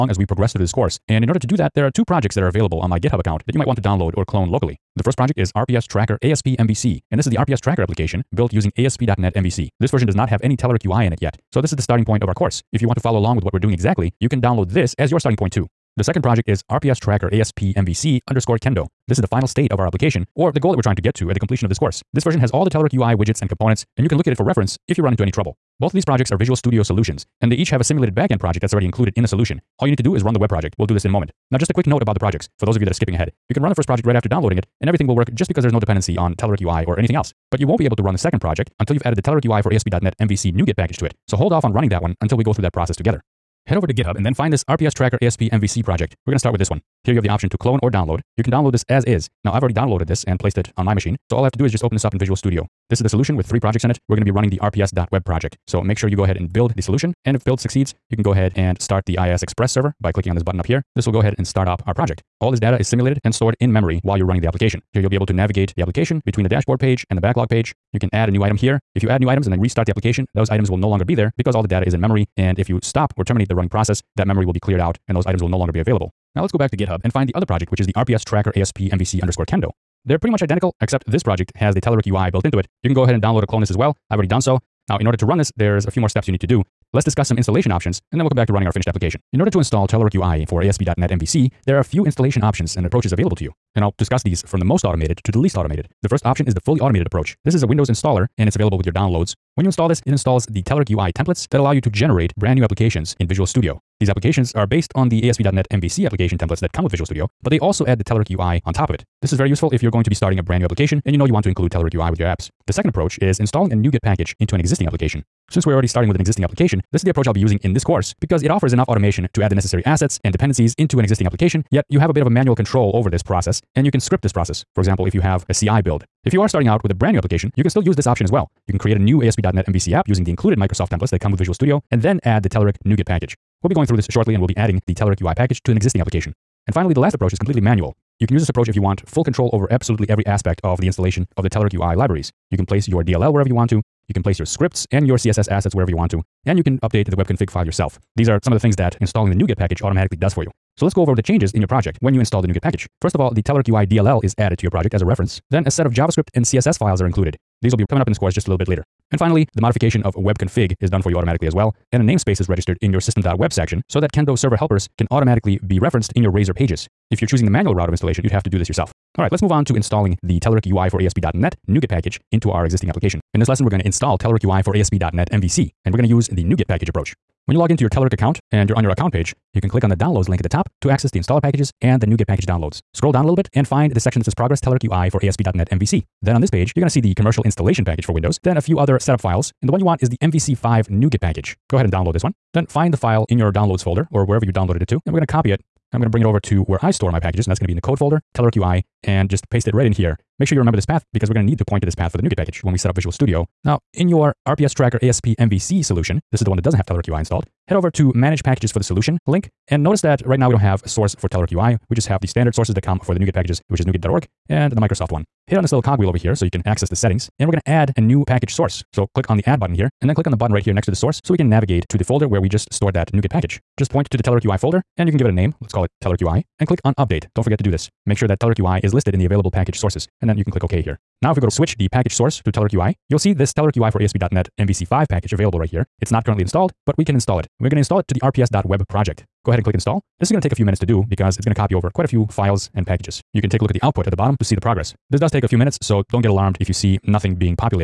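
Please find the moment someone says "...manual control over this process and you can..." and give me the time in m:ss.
2:02.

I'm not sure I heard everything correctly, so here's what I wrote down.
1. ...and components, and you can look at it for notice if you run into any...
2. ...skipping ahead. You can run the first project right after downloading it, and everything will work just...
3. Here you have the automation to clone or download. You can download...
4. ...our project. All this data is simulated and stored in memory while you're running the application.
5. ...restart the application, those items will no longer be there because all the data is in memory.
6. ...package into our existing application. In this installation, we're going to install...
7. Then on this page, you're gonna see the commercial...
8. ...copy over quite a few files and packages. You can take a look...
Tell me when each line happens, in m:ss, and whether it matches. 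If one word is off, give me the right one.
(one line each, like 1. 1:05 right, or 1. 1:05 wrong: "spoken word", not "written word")
1. 0:23 wrong: "reference", not "notice"
2. 0:32 right
3. 0:47 wrong: "option", not "automation"
4. 1:01 right
5. 1:09 right
6. 2:51 wrong: "lesson", not "installation"
7. 3:06 right
8. 4:01 right.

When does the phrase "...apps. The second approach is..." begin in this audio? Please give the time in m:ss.
1:52.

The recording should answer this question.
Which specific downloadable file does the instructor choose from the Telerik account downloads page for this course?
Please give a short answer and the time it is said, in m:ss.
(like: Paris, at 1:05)
MVC5 NuGet package, at 3:10.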